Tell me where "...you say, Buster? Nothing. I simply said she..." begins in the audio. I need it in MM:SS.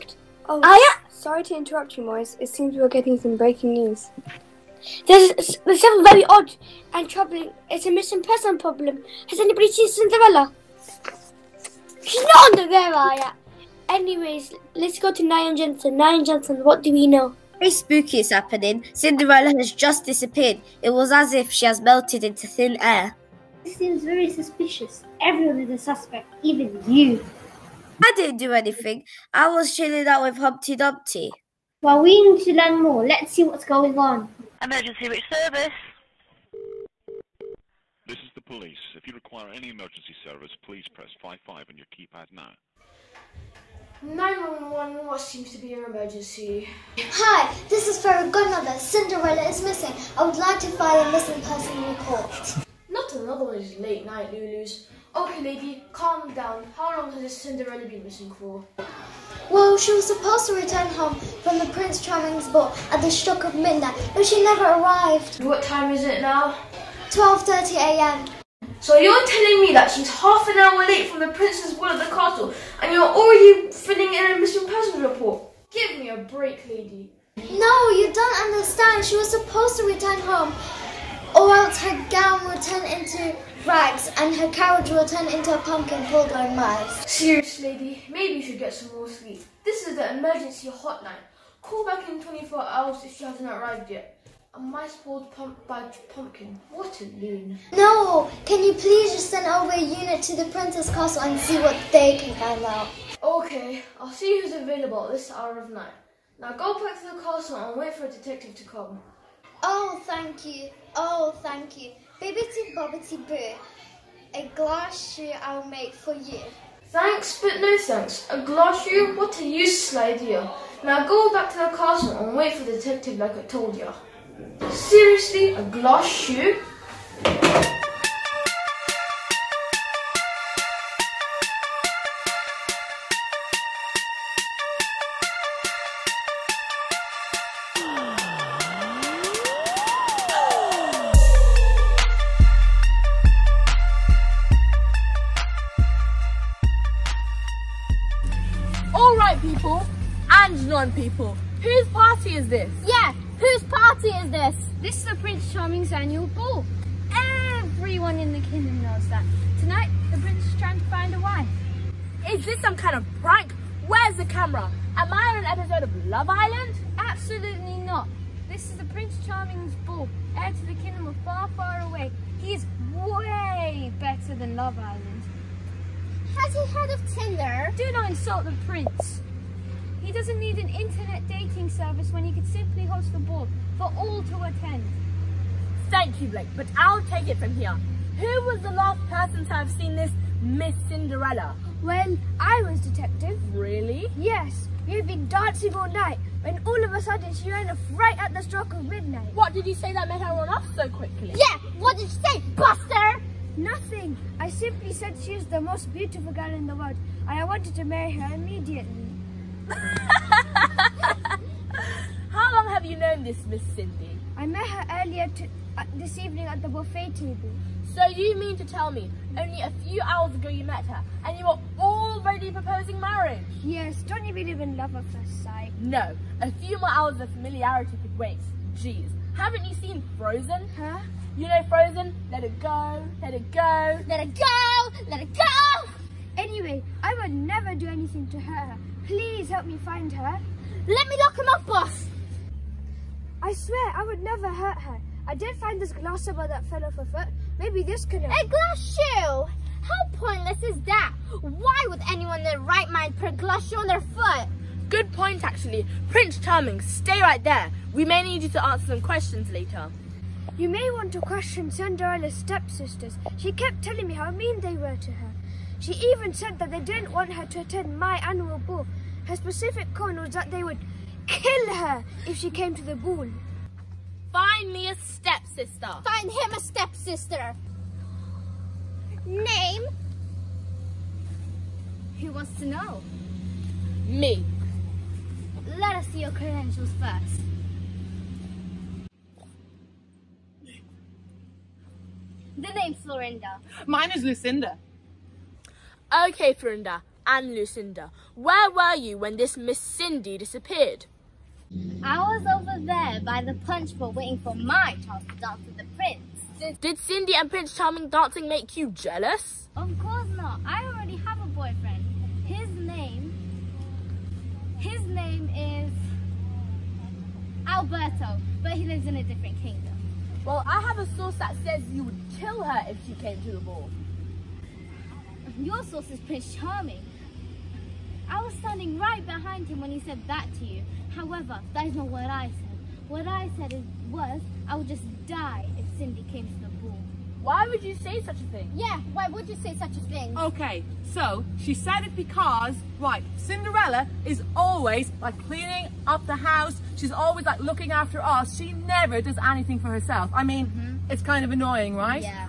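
03:22.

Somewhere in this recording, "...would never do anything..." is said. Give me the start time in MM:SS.
03:57.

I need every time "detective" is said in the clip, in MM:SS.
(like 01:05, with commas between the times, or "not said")
01:48, 02:02, 03:12.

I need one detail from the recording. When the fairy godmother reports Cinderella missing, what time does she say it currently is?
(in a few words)
12:30 a.m.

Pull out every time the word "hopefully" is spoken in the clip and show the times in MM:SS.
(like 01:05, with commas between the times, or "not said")
not said.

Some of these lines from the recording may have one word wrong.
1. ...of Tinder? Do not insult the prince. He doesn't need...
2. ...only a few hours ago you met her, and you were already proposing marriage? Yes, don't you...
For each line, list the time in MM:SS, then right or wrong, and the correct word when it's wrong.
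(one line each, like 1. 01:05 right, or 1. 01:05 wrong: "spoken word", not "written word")
1. 02:56 right
2. 03:39 right.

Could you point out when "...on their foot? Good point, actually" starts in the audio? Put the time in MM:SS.
04:13.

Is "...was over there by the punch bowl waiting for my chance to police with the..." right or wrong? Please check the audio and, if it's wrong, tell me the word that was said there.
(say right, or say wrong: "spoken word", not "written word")
wrong: "dance", not "police".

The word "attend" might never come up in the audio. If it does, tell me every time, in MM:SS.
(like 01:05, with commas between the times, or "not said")
03:04, 04:27.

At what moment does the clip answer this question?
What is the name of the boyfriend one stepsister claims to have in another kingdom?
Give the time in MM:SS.
05:17.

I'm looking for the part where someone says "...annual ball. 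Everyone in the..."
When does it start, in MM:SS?
02:35.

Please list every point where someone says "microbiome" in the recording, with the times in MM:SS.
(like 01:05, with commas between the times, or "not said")
not said.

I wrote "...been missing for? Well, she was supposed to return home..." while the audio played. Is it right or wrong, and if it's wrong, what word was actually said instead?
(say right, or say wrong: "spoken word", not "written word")
right.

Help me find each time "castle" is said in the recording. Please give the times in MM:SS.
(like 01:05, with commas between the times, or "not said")
01:12, 01:40, 01:47, 02:01.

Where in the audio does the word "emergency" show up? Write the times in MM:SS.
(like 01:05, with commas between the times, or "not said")
00:34, 00:39, 00:45, 01:30.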